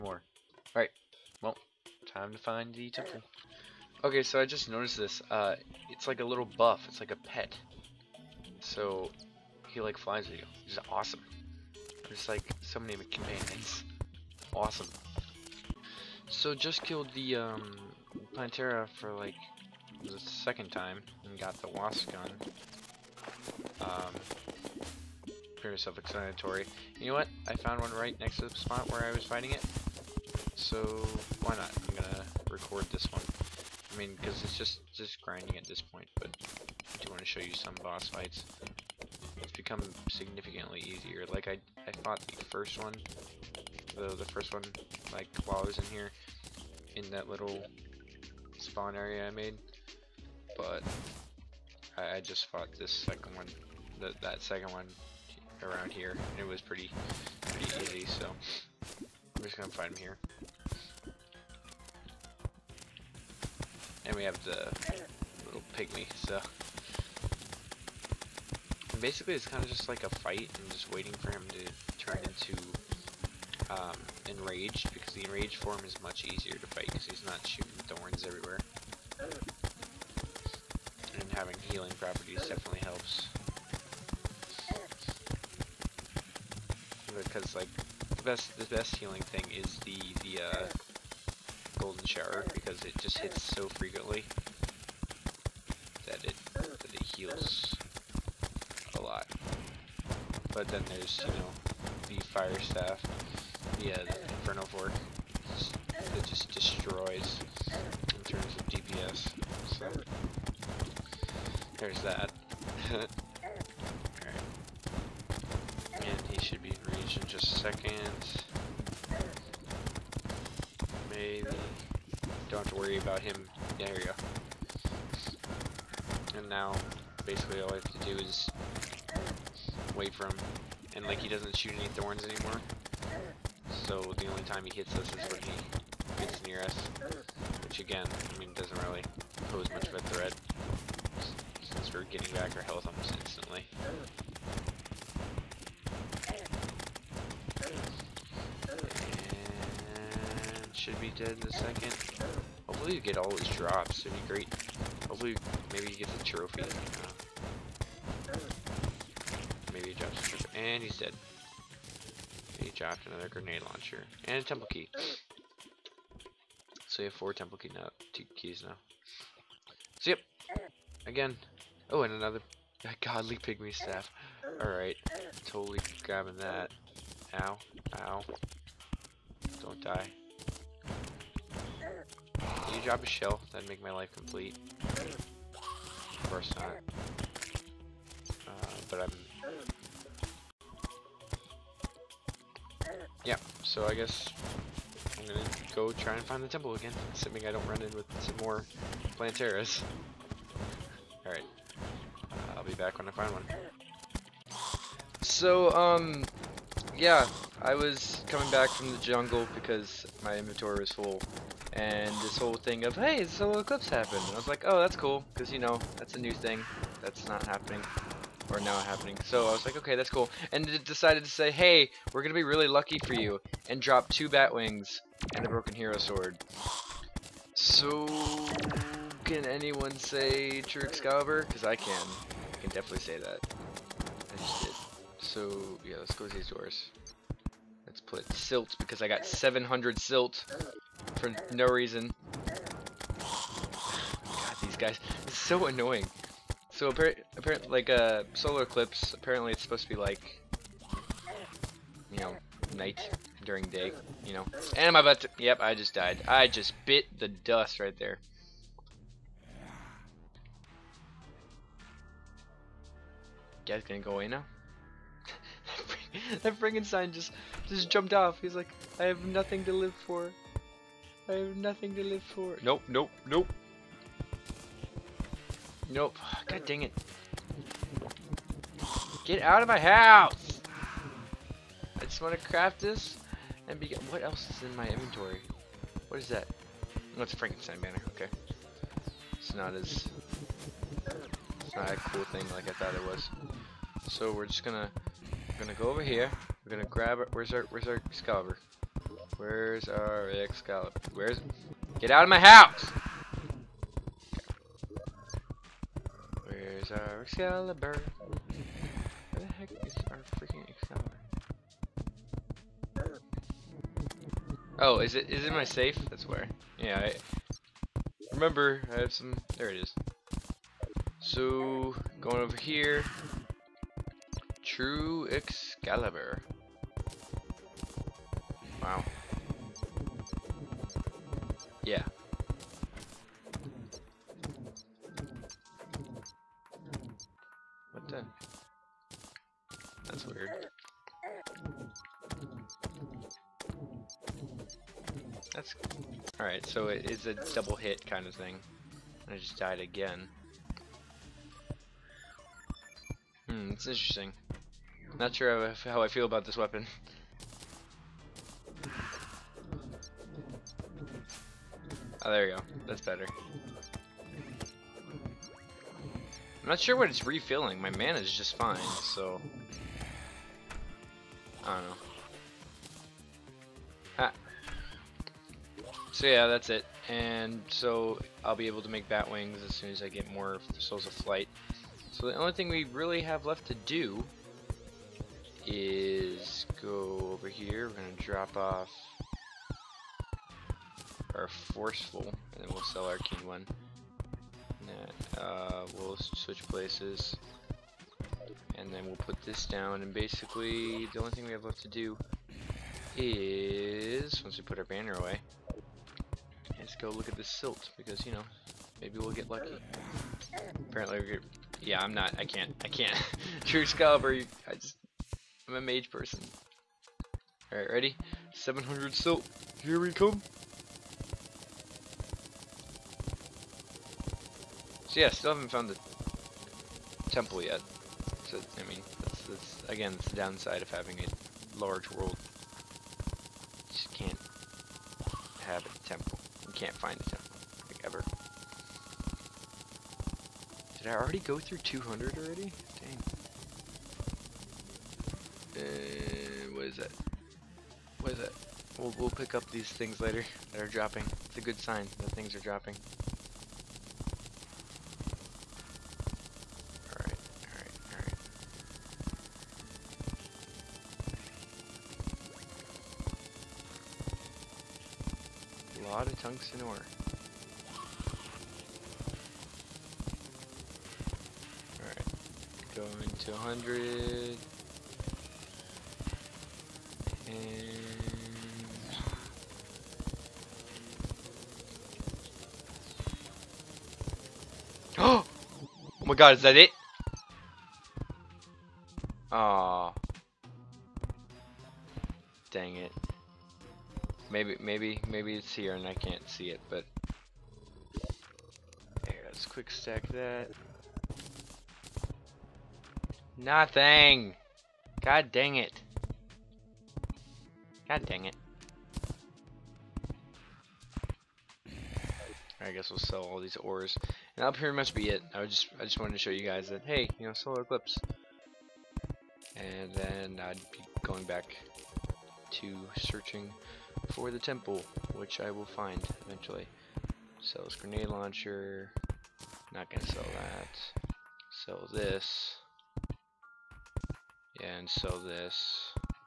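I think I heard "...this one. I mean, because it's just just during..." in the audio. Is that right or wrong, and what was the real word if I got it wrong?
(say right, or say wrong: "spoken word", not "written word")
wrong: "grinding", not "during".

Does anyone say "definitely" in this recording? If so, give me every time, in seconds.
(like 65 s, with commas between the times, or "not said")
82 s, 232 s.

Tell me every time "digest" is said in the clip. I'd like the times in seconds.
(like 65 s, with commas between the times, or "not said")
not said.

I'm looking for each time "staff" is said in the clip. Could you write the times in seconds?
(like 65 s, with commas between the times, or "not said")
102 s, 173 s.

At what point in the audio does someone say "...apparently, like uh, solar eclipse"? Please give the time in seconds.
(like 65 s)
246 s.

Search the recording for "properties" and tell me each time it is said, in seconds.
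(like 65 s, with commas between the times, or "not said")
81 s.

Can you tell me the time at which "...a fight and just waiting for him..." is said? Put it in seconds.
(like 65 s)
70 s.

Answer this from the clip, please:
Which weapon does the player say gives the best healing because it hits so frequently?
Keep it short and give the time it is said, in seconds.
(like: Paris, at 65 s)
shower, at 92 s.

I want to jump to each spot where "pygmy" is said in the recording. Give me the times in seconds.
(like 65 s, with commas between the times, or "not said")
65 s, 173 s.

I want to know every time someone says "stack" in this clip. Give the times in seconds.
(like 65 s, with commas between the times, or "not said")
499 s.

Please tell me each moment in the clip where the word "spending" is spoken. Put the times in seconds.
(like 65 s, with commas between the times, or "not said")
not said.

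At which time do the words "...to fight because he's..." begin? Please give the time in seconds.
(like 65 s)
76 s.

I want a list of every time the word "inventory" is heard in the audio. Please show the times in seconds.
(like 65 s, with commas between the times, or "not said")
210 s, 284 s.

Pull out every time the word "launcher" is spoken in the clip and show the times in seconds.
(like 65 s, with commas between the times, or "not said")
163 s, 528 s.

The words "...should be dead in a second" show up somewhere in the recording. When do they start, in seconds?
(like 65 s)
150 s.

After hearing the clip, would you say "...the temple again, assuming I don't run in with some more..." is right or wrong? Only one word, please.
right.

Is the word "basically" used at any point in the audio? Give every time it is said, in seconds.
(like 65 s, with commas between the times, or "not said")
69 s, 127 s, 400 s.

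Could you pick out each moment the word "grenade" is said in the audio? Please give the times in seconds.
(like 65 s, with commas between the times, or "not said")
163 s, 527 s.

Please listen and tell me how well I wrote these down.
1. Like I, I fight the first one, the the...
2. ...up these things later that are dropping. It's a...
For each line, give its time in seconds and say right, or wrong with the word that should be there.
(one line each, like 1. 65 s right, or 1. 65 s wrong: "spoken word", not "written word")
1. 41 s wrong: "fought", not "fight"
2. 449 s right.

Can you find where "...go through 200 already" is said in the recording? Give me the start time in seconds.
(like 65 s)
441 s.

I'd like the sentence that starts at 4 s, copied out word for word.
Okay, so I just noticed this.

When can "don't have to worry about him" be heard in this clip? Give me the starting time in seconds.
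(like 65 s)
122 s.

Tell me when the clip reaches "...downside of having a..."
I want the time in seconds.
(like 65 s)
430 s.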